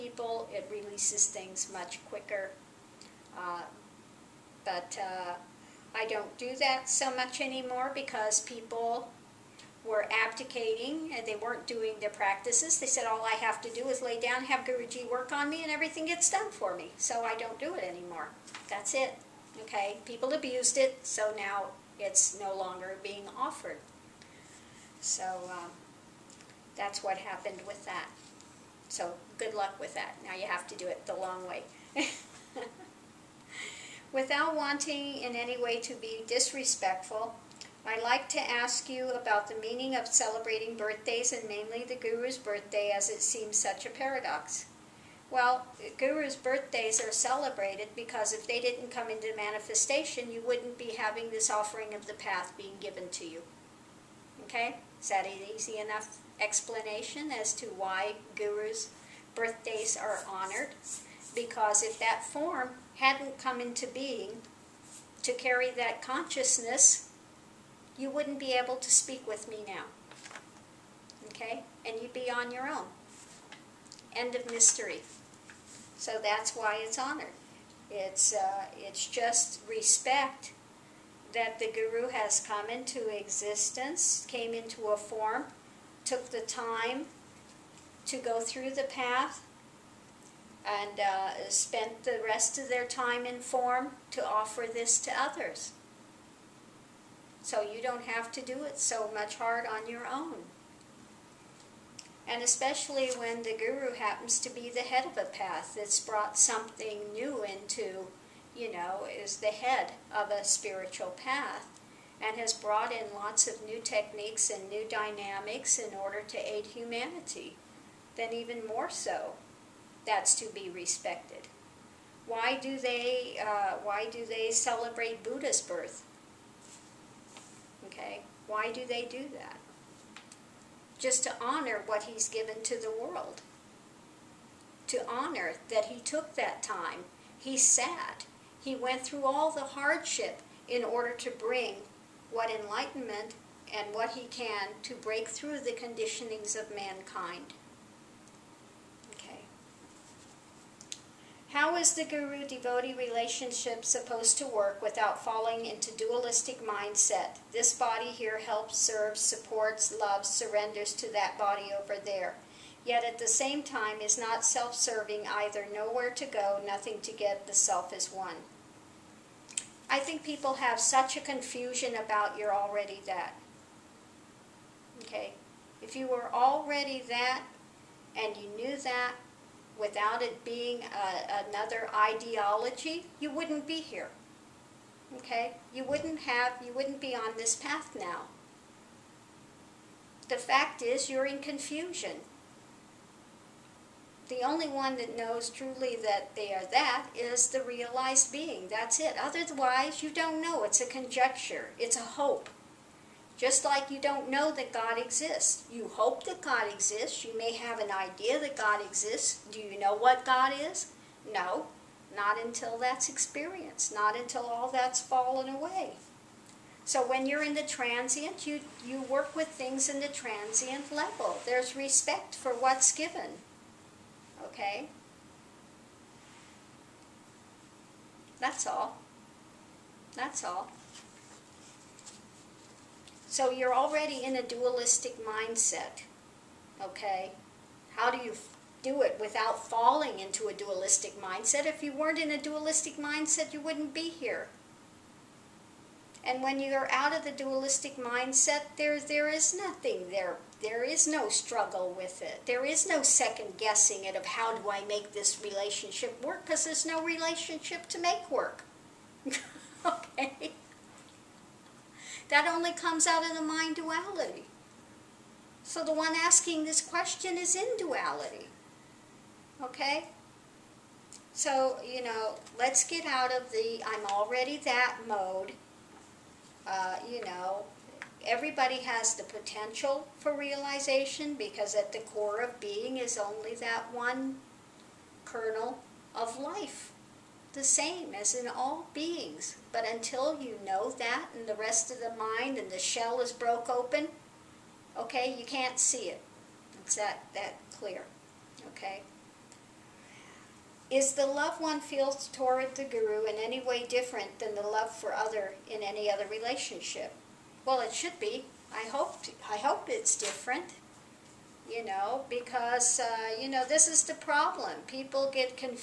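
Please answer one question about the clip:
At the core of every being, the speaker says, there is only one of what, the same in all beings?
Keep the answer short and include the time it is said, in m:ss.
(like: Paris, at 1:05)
kernel of life, at 4:45.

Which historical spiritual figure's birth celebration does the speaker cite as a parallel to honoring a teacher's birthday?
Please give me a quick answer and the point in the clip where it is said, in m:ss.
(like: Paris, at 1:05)
Buddha, at 2:05.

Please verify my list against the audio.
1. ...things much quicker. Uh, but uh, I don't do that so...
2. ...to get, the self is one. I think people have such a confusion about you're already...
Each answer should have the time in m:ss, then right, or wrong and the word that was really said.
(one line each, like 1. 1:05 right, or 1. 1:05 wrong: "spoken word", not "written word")
1. 0:01 right
2. 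2:47 right.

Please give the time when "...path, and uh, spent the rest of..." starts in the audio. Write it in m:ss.
1:28.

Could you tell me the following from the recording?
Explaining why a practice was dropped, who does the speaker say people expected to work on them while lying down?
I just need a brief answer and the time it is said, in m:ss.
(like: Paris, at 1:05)
Guruji, at 0:14.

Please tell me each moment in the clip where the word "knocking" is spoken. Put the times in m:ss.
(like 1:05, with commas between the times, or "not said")
not said.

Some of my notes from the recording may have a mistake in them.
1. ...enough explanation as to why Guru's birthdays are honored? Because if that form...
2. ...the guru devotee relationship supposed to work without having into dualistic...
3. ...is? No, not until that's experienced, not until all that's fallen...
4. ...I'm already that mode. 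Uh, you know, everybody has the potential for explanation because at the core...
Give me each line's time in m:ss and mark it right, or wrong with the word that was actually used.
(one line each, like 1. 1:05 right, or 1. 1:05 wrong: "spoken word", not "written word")
1. 0:55 right
2. 2:31 wrong: "falling", not "having"
3. 3:30 right
4. 4:33 wrong: "realization", not "explanation".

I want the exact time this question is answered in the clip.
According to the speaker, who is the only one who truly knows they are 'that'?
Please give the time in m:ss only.
3:17.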